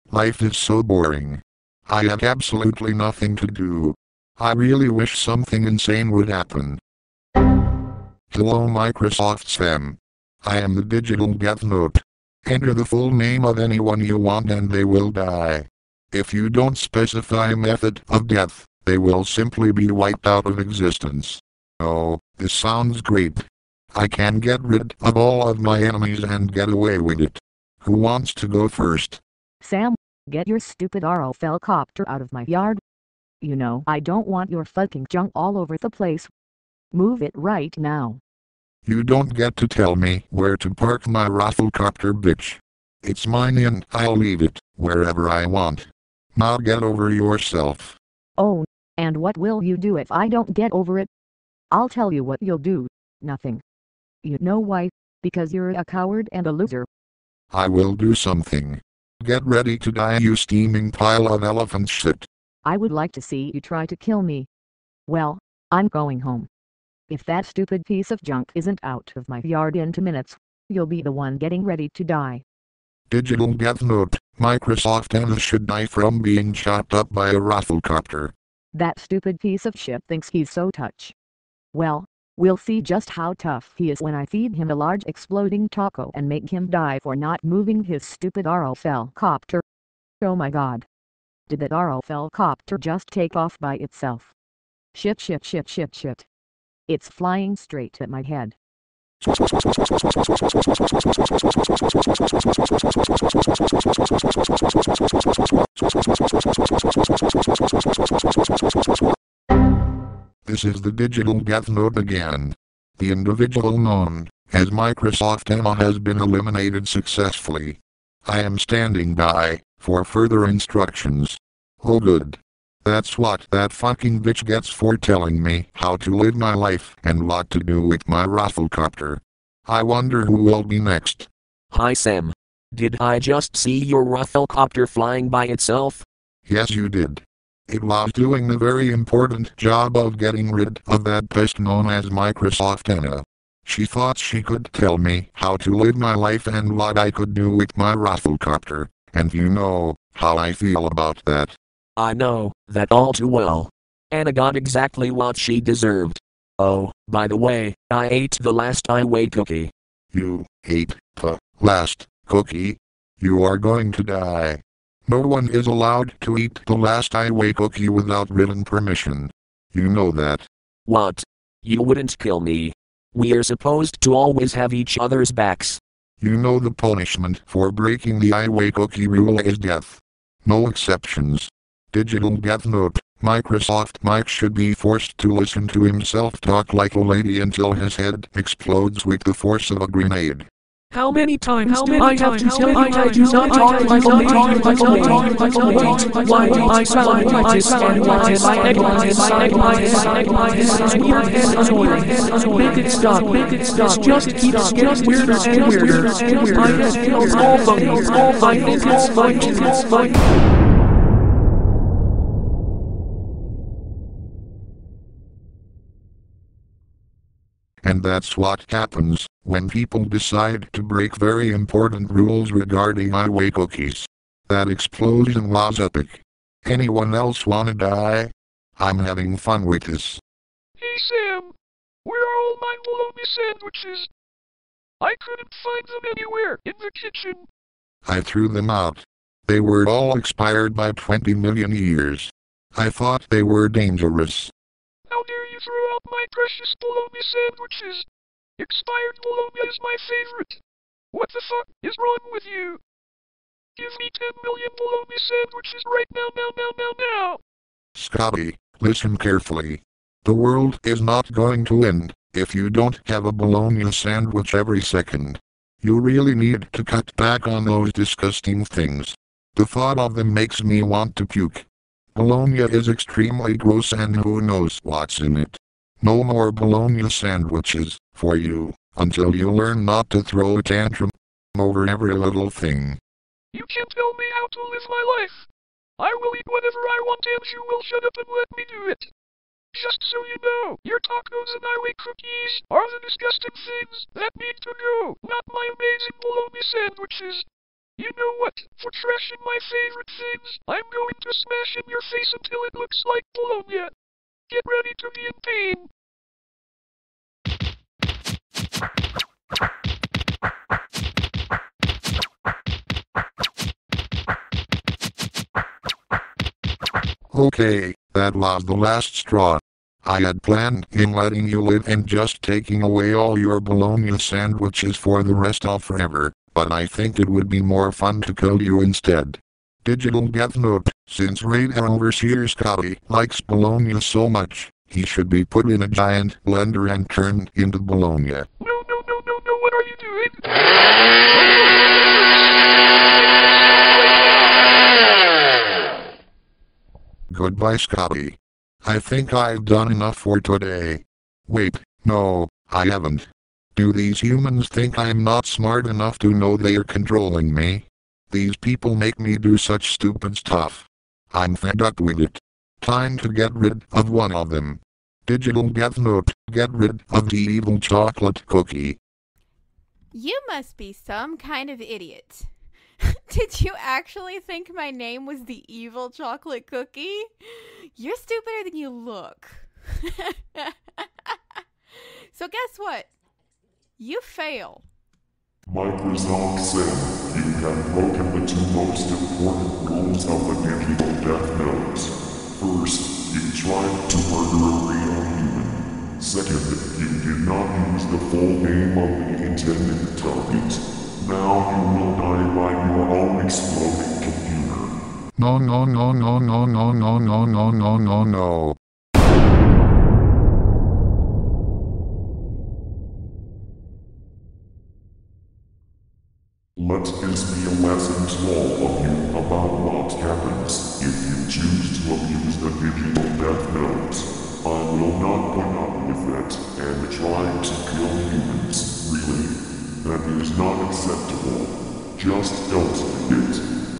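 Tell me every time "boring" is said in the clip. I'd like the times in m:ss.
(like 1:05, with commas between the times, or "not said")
0:00.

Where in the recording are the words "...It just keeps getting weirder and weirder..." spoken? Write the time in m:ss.
3:23.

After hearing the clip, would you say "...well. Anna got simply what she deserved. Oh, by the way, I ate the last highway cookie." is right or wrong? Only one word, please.
wrong.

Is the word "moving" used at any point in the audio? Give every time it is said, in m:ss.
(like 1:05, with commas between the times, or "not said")
1:27.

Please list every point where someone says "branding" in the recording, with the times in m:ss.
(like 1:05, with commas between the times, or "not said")
not said.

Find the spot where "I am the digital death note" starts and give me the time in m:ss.
0:10.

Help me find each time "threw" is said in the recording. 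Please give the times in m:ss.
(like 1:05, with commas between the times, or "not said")
3:58, 4:05.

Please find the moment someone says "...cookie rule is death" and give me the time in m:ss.
2:58.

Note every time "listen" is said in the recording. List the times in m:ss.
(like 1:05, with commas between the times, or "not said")
3:05, 4:18.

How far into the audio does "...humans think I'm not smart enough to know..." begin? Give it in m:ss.
5:54.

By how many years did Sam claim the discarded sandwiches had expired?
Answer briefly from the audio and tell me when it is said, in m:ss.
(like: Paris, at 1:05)
20 million, at 4:00.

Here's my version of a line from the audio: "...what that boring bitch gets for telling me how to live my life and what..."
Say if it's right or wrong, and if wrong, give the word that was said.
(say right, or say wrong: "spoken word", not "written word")
wrong: "fucking", not "boring".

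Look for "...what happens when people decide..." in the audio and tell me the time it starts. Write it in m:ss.
3:38.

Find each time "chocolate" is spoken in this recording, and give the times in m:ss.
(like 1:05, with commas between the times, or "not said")
6:07, 6:16.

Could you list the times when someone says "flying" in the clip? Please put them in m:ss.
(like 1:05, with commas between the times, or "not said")
1:37, 2:14.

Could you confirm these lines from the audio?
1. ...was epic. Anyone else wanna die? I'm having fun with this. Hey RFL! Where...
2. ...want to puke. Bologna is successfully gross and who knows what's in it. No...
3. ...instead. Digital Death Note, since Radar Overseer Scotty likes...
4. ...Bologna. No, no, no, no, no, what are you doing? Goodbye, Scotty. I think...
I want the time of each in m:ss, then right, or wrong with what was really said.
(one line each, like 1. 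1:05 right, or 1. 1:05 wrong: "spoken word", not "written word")
1. 3:45 wrong: "Sam", not "RFL"
2. 4:30 wrong: "extremely", not "successfully"
3. 5:28 right
4. 5:37 right.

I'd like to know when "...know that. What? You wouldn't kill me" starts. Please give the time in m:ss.
2:49.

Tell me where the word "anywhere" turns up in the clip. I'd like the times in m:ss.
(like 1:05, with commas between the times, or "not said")
3:56.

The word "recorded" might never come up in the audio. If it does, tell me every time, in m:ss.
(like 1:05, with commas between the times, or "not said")
not said.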